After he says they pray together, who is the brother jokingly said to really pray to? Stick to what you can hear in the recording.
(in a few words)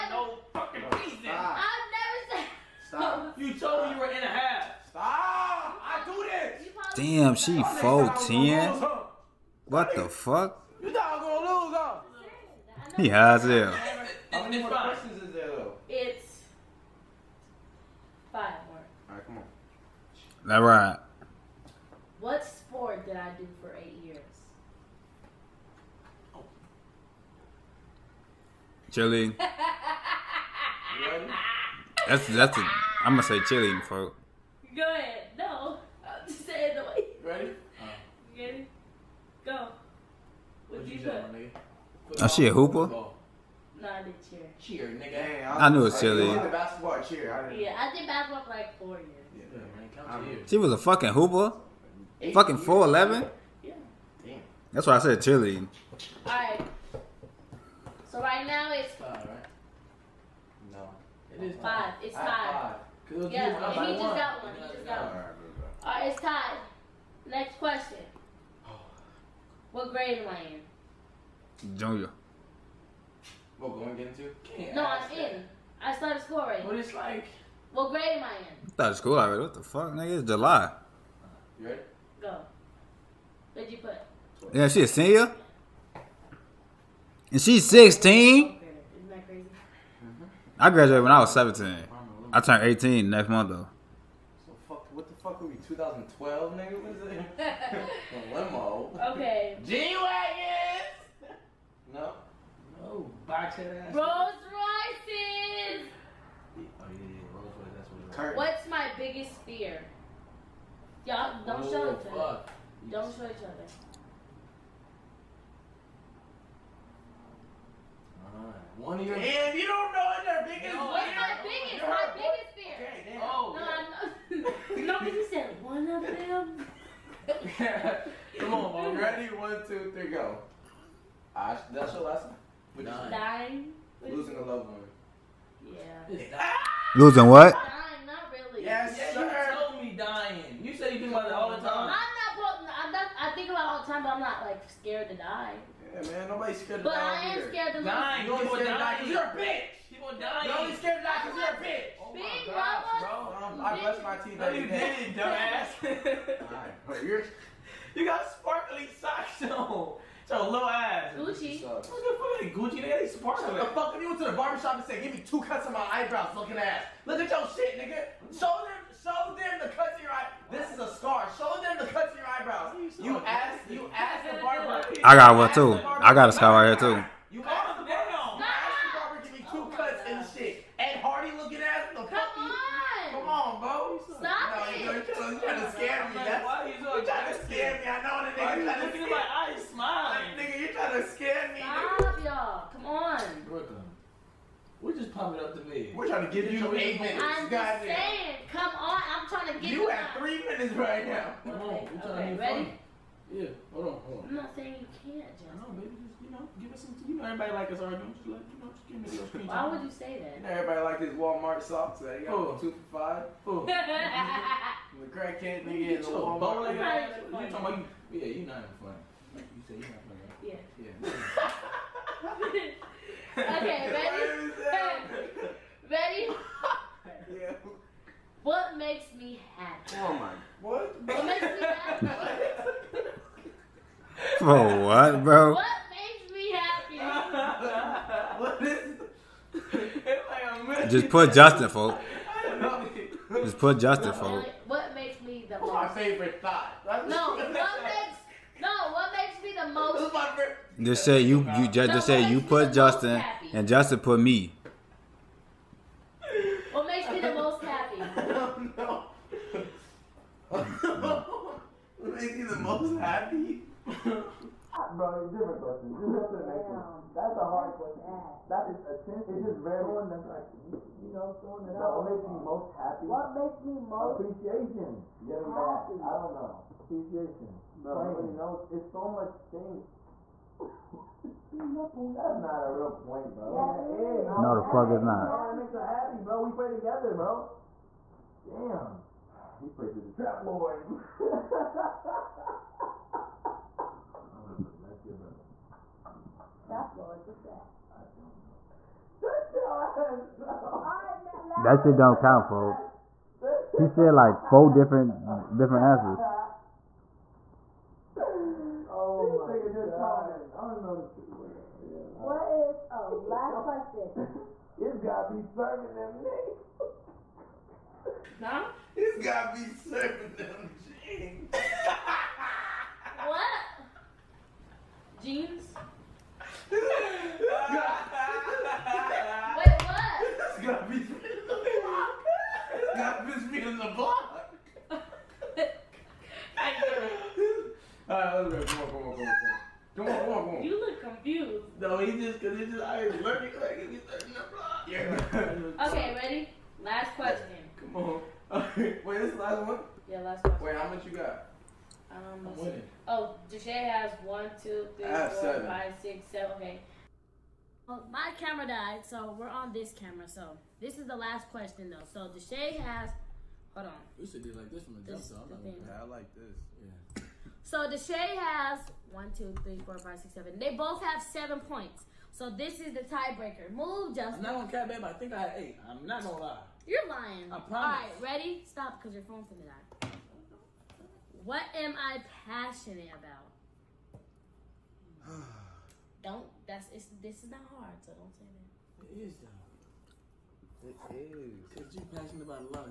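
The trap lords.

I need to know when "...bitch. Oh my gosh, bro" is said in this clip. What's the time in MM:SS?
02:31.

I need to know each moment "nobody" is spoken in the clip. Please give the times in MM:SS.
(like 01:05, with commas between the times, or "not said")
02:26, 04:38.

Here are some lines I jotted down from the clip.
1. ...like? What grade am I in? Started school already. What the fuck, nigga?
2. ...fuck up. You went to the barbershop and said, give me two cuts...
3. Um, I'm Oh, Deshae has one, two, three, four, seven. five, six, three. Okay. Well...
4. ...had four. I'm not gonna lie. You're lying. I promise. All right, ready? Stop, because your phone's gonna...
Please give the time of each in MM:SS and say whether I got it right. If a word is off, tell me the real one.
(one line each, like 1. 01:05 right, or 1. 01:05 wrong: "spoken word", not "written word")
1. 01:16 right
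2. 02:43 right
3. 05:52 wrong: "seven", not "three"
4. 06:15 wrong: "eight", not "four".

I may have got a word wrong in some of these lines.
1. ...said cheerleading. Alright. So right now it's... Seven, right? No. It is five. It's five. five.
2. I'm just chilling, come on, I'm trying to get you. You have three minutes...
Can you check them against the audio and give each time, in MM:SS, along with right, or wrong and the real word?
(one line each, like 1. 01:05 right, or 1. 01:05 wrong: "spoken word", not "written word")
1. 00:54 wrong: "Five", not "Seven"
2. 03:17 wrong: "saying", not "chilling".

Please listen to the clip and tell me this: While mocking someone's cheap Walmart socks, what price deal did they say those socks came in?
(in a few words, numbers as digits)
2 for 5.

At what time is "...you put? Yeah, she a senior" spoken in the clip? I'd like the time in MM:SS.
01:23.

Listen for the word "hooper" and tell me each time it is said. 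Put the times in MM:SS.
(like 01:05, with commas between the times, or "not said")
00:42, 00:51.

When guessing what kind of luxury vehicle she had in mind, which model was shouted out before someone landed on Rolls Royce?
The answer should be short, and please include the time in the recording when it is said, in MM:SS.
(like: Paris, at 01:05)
G-Wagon, at 01:39.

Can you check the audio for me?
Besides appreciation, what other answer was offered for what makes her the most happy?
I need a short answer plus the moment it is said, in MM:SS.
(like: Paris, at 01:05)
Giving back, at 04:35.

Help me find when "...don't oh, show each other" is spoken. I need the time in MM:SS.
01:51.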